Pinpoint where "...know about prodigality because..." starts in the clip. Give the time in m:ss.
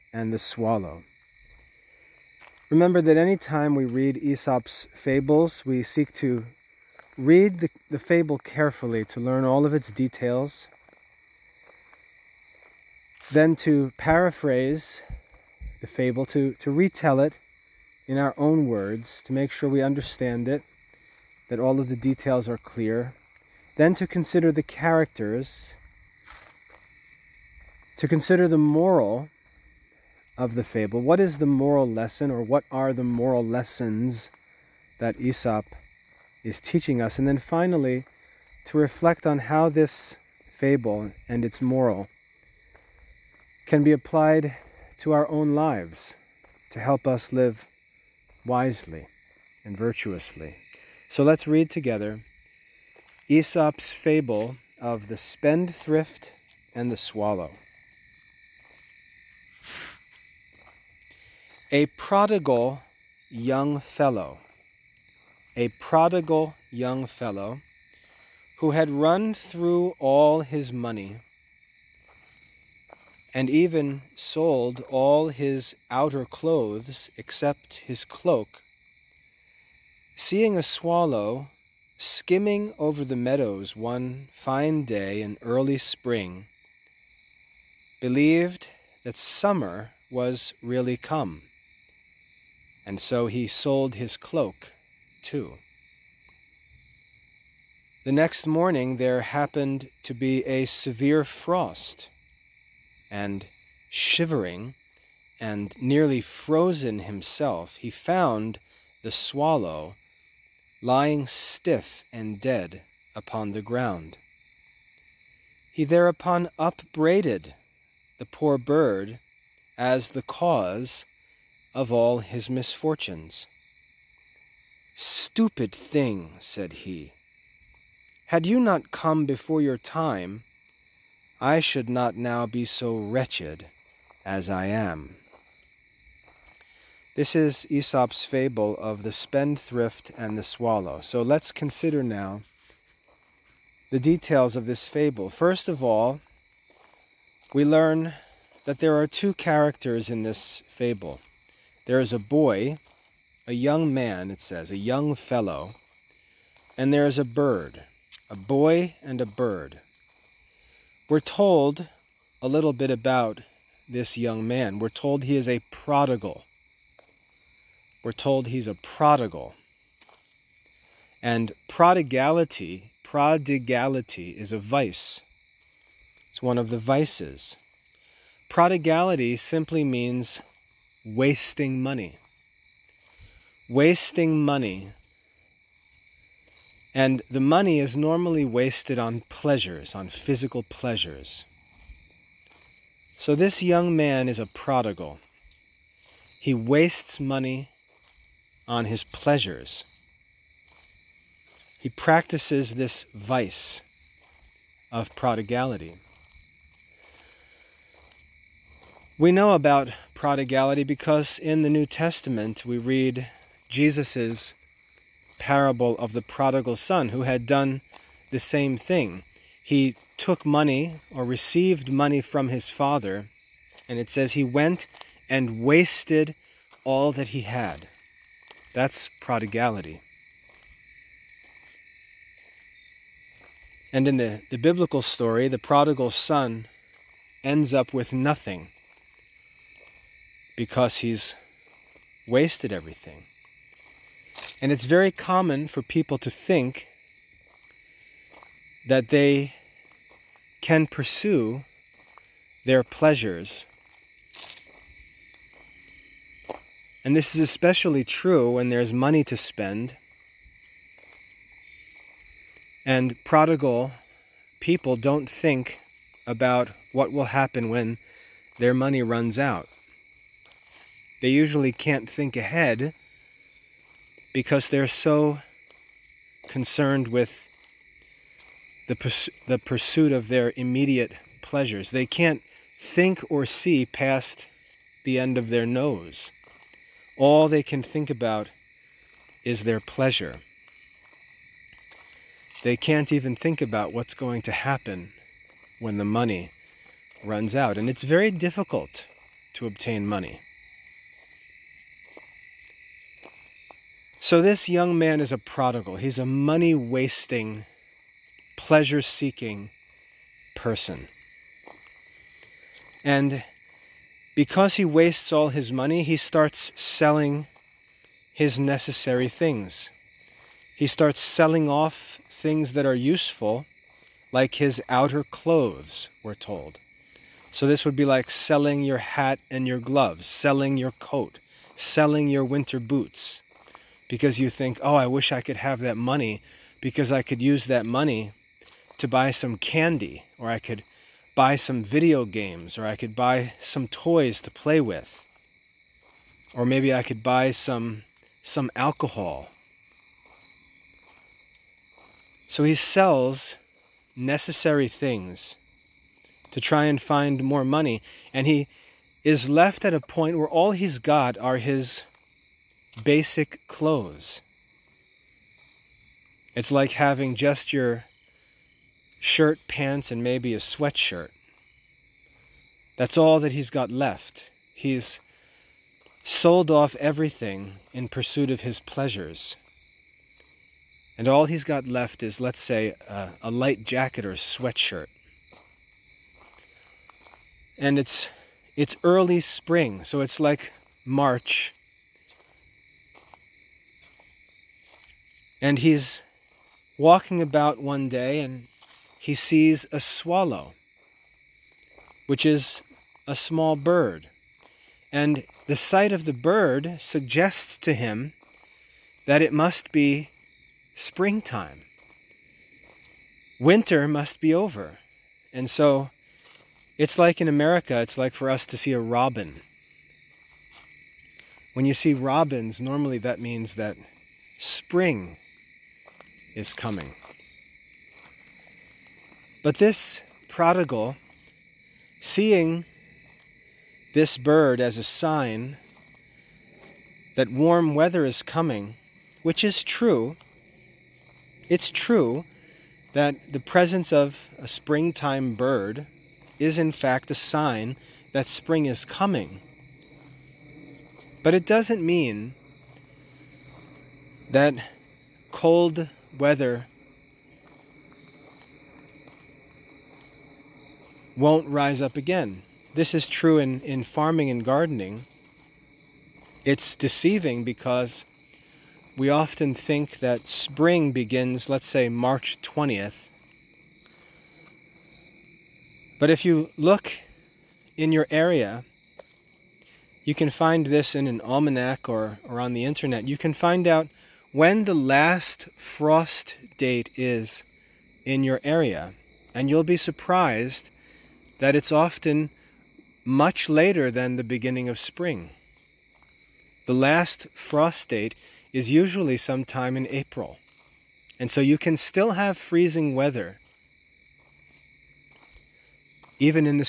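3:29.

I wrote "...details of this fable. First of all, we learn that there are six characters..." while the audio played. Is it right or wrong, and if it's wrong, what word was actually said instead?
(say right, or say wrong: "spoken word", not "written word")
wrong: "two", not "six".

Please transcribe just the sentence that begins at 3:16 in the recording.
He wastes money on his pleasures.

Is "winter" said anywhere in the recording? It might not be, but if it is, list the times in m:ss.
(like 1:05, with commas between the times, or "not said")
5:32, 6:53.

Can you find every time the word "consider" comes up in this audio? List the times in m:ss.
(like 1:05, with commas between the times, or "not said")
0:24, 0:28, 2:21.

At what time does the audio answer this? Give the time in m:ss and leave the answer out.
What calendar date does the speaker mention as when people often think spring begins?
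7:52.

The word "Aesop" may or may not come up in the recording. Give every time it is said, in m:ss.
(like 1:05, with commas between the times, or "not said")
0:04, 0:35, 0:53, 2:17.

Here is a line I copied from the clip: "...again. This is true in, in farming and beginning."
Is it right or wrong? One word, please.
wrong.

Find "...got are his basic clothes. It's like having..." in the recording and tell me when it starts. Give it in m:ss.
6:00.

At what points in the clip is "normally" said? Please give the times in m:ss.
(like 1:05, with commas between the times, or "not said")
3:07, 7:02.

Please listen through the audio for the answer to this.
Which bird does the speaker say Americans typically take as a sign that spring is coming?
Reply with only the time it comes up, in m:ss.
6:58.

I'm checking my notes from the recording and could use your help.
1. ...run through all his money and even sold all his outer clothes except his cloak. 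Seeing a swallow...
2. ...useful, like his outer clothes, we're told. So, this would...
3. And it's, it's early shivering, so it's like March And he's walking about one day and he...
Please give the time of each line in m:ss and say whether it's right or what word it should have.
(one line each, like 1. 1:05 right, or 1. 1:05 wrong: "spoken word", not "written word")
1. 1:08 right
2. 5:22 right
3. 6:27 wrong: "spring", not "shivering".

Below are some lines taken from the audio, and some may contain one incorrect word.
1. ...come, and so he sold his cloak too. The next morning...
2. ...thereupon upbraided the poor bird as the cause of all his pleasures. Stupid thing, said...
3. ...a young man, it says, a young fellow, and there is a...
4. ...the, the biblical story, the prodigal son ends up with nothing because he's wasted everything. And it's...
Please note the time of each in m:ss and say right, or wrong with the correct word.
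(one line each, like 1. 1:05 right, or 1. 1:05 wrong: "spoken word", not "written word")
1. 1:30 right
2. 1:55 wrong: "misfortunes", not "pleasures"
3. 2:33 right
4. 3:54 right.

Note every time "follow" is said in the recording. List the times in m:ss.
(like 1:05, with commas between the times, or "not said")
not said.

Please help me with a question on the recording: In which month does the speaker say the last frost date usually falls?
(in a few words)
April.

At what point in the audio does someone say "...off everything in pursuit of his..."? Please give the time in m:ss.
6:16.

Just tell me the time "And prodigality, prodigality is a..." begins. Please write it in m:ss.
2:51.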